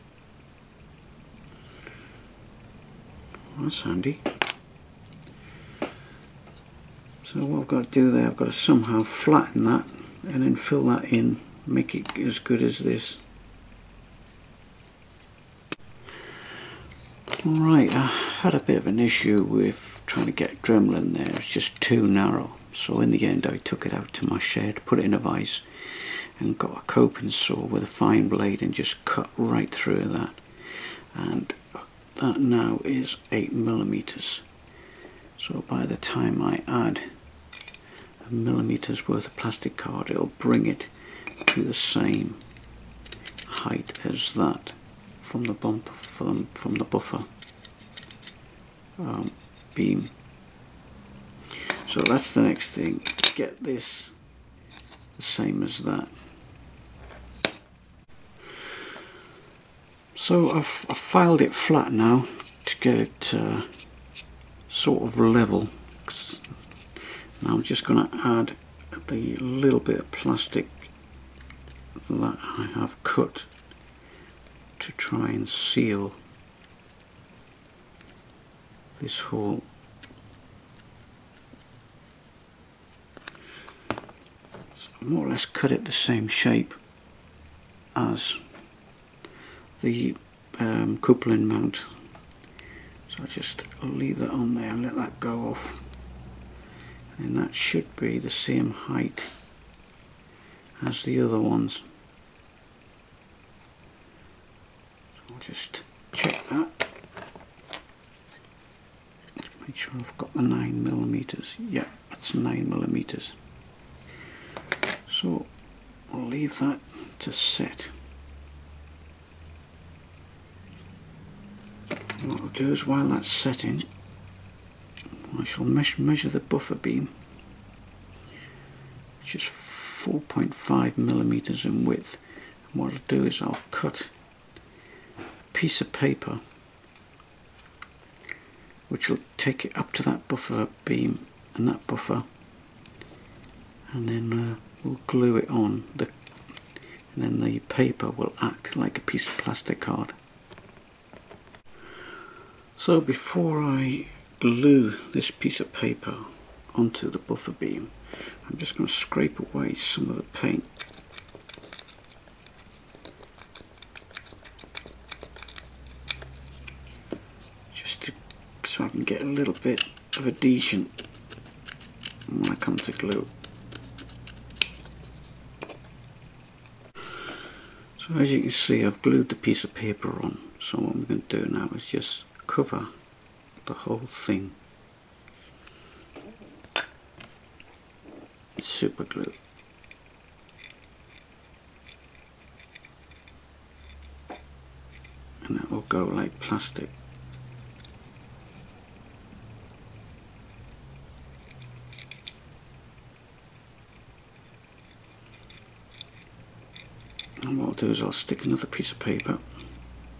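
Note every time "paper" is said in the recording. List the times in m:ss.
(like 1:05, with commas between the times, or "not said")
2:15, 2:27, 2:35, 2:59, 3:28.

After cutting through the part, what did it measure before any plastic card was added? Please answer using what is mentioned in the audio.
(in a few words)
8 millimeters.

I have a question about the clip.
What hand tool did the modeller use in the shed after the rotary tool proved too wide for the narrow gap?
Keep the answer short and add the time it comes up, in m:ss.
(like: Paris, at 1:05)
coping saw, at 0:26.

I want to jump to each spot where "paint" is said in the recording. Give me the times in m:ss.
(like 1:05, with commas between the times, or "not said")
2:40.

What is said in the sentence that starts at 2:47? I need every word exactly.
Just to, so I can get a little bit of adhesion when I come to glue.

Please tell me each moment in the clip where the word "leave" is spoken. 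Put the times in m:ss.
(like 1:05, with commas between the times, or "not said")
1:33, 1:56.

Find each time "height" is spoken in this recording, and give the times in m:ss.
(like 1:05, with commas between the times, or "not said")
0:43, 1:38.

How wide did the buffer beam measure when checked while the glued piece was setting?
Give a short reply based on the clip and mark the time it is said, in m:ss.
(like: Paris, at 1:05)
4.5 millimeters, at 2:10.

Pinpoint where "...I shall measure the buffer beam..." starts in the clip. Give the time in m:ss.
2:05.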